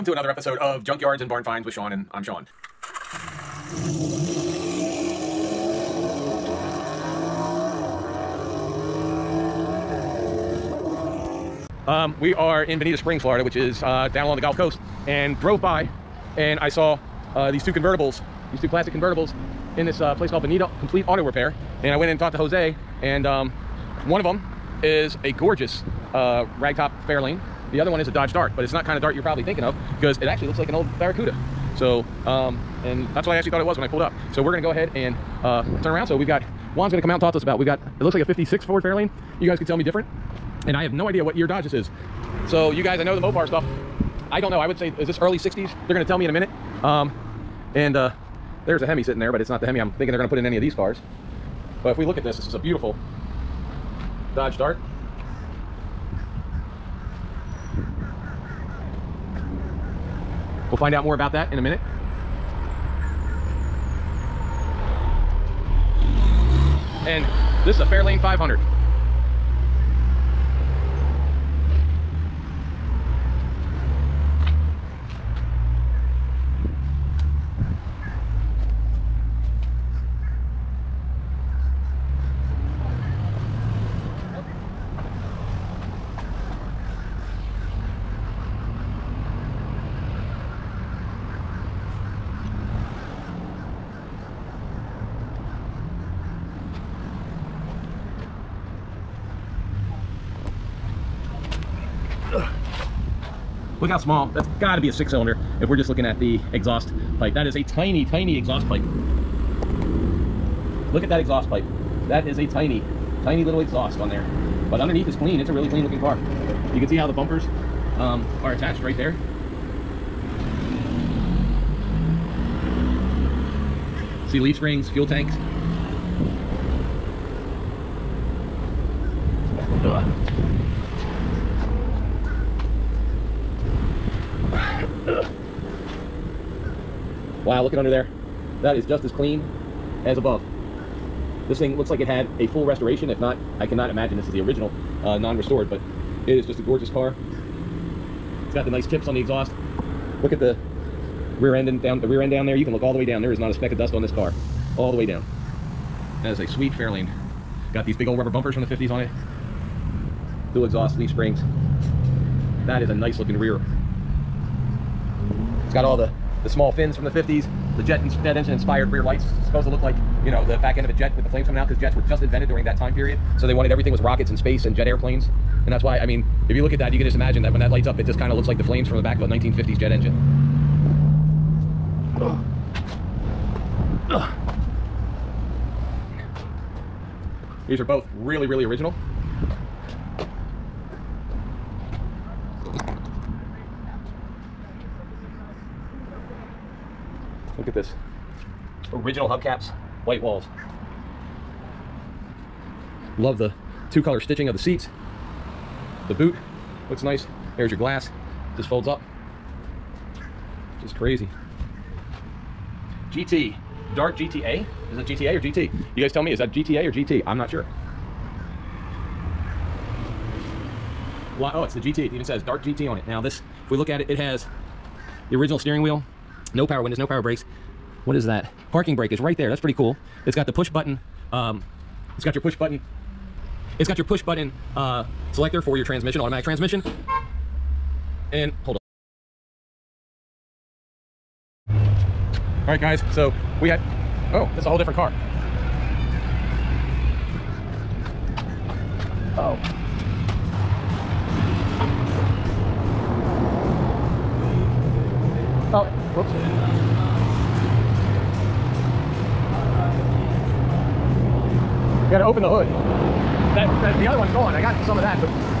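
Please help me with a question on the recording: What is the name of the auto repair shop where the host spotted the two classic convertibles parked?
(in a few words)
Benito Complete Auto Repair.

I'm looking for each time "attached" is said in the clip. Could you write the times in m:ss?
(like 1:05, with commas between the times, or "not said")
1:58.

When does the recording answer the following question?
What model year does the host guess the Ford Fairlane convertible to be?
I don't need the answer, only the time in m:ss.
0:38.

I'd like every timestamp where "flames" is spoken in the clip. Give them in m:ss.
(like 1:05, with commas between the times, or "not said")
2:51, 2:58.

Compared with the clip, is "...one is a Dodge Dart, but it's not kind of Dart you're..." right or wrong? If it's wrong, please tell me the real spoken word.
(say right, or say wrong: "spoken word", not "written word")
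right.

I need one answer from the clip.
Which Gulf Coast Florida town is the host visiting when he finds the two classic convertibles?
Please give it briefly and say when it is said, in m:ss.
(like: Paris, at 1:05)
Bonita Springs, at 0:12.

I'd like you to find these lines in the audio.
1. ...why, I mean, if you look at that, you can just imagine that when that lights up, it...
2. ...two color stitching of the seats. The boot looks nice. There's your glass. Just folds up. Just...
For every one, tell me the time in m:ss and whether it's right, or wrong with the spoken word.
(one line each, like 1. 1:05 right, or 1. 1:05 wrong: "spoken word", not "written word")
1. 2:55 right
2. 3:23 right.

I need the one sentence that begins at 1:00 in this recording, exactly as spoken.
We'll find out more about that in a minute.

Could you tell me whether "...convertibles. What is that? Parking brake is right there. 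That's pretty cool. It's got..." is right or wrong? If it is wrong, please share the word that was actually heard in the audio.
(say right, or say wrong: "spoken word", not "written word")
wrong: "brakes", not "convertibles".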